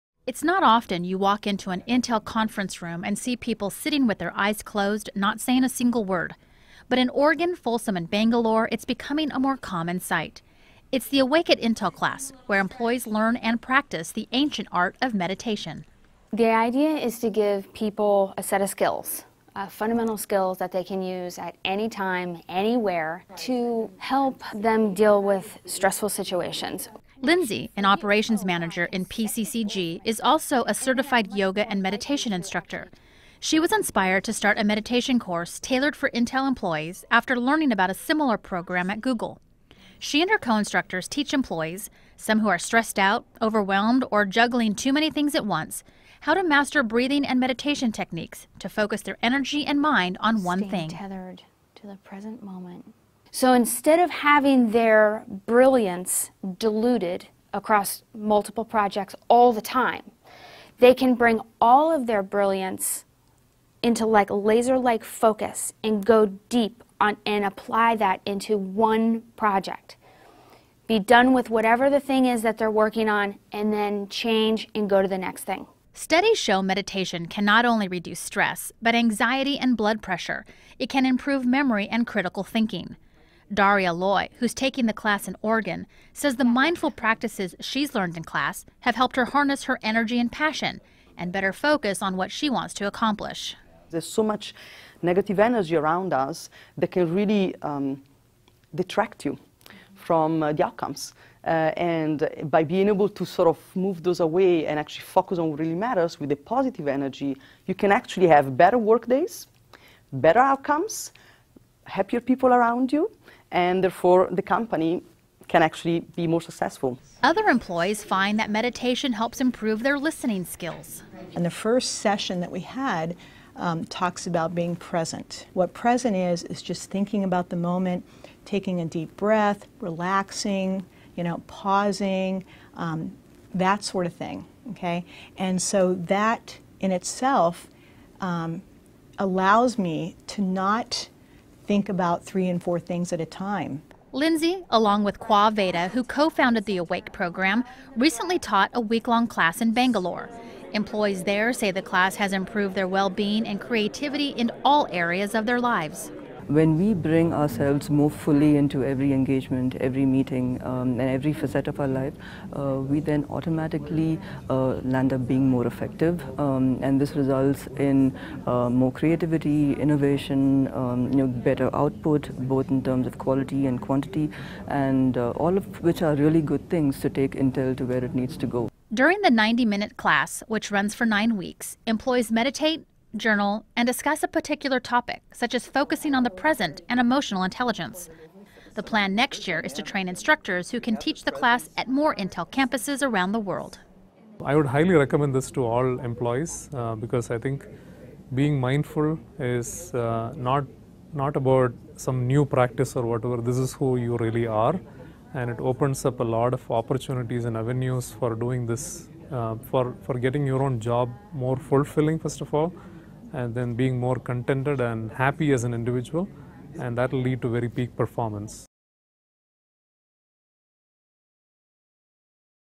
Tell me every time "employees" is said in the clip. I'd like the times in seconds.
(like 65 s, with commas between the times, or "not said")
12 s, 36 s, 41 s, 117 s, 150 s, 181 s, 195 s.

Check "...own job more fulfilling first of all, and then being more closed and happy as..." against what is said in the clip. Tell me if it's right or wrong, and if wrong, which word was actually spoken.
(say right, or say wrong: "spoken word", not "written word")
wrong: "contented", not "closed".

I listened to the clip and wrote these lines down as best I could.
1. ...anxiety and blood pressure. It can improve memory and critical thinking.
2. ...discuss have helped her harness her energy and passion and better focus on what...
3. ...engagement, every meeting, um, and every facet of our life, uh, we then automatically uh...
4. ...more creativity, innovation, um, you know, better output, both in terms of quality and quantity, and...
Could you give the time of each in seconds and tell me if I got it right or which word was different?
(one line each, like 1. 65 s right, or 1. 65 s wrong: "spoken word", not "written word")
1. 78 s right
2. 88 s wrong: "class", not "discuss"
3. 159 s right
4. 168 s right.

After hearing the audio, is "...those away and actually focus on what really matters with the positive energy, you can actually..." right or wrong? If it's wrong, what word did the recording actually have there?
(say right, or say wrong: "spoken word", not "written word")
right.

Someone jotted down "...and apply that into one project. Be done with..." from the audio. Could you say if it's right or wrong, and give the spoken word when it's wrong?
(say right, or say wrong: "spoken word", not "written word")
right.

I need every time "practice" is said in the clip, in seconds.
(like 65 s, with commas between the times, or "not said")
13 s, 86 s, 202 s.